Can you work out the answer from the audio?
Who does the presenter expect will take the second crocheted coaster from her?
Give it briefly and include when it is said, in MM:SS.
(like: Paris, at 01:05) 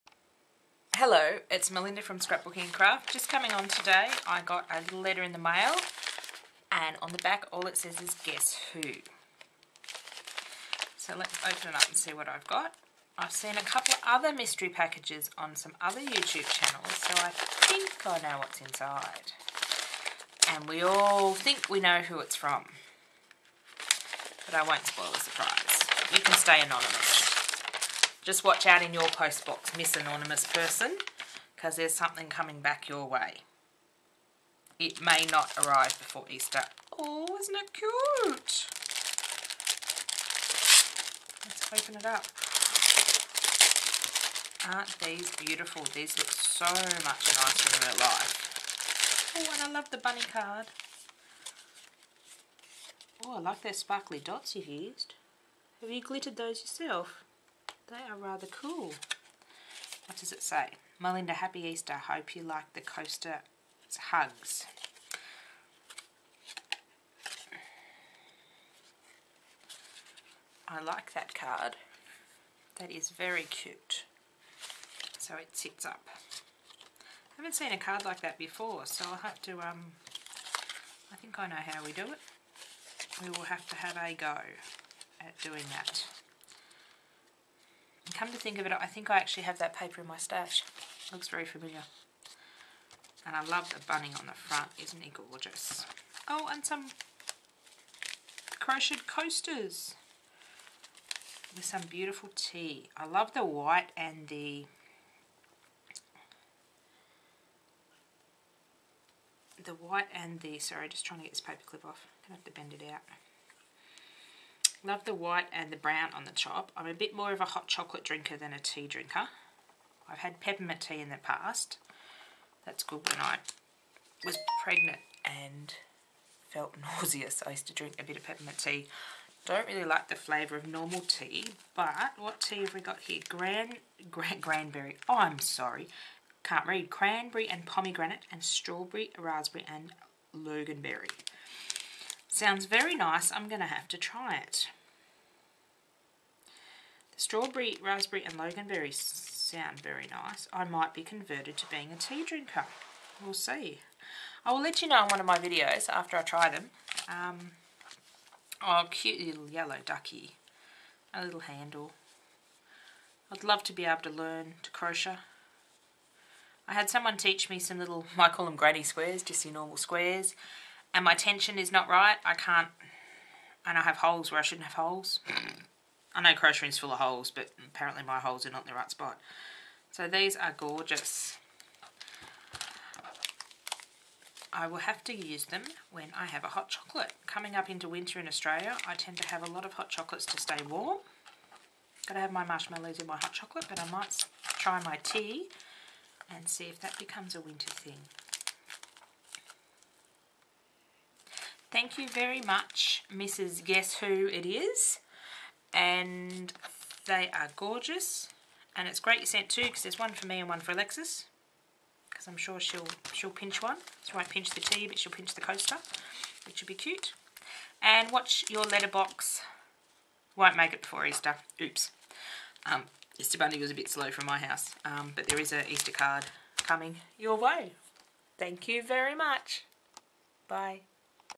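Alexis, at 03:30.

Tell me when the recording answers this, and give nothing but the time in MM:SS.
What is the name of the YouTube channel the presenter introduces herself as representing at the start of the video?
00:02.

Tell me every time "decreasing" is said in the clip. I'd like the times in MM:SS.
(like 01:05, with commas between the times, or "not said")
not said.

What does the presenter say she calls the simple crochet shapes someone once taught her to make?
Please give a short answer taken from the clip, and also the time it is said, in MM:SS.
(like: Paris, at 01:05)
Granny squares, at 02:48.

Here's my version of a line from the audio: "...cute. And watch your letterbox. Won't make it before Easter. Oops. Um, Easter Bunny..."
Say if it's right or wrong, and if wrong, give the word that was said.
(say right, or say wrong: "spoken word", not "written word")
right.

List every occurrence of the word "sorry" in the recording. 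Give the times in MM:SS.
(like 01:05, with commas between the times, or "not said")
01:50, 02:15.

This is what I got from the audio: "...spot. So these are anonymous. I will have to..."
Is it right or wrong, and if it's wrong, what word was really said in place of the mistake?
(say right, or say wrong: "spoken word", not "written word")
wrong: "gorgeous", not "anonymous".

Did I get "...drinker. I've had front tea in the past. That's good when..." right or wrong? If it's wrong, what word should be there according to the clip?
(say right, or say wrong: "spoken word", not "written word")
wrong: "peppermint", not "front".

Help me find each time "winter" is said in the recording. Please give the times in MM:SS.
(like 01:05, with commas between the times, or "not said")
03:07, 03:17.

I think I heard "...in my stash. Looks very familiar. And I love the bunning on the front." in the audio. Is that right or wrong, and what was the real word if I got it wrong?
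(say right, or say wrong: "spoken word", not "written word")
right.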